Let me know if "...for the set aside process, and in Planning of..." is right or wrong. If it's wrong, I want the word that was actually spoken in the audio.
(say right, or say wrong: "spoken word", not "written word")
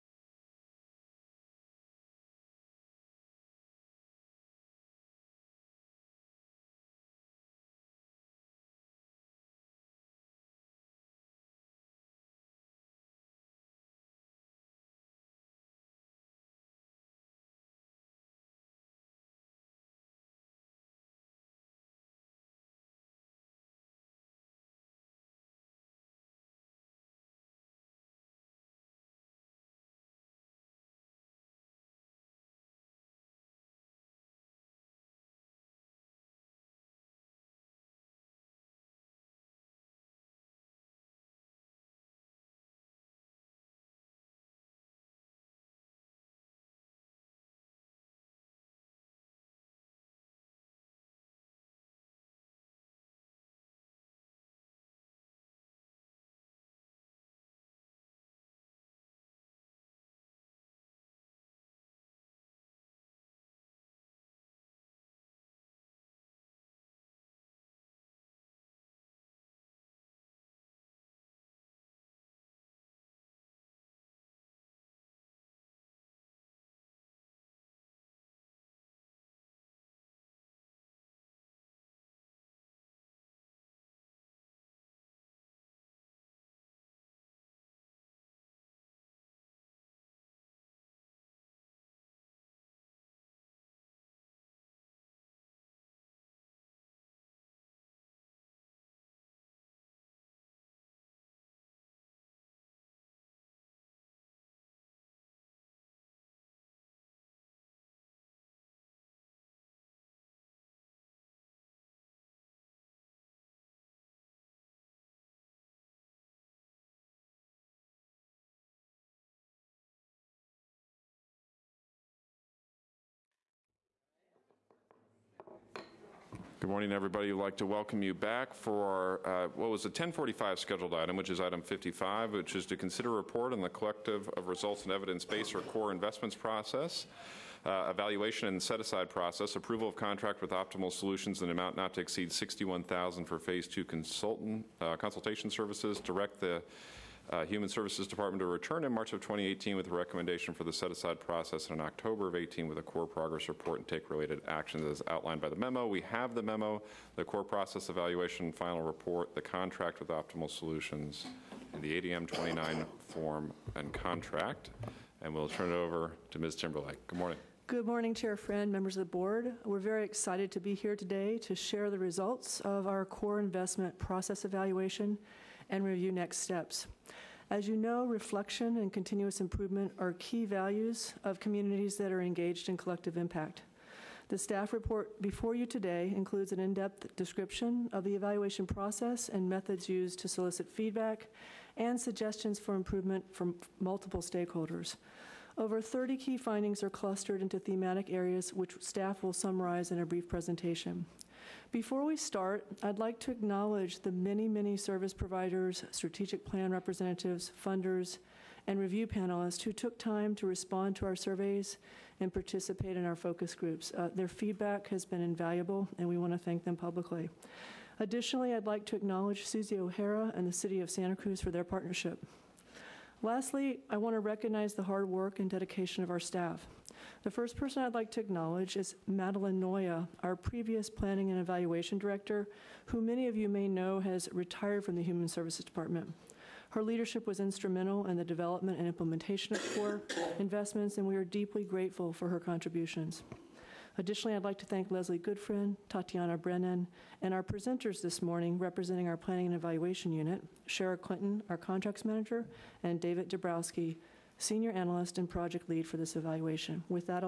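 wrong: "October", not "Planning".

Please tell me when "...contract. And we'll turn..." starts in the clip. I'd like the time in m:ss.
2:43.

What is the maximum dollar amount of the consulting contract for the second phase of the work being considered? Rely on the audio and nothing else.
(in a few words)
$61,000.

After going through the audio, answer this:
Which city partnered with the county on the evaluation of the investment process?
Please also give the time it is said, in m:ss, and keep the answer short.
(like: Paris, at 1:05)
Santa Cruz, at 3:40.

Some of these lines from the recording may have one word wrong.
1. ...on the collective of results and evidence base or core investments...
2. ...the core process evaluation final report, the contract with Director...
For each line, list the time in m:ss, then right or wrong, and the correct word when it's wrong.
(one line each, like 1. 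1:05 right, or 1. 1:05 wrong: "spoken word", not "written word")
1. 2:13 right
2. 2:37 wrong: "Optimal", not "Director".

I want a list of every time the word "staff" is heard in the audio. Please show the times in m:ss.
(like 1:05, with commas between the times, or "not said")
3:04, 3:18, 3:46.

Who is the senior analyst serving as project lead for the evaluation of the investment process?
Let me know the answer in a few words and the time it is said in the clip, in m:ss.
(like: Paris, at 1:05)
David Dabrowski, at 4:12.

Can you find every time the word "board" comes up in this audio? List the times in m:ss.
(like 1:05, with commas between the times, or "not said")
2:49.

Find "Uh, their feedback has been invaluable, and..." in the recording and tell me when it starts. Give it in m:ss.
3:33.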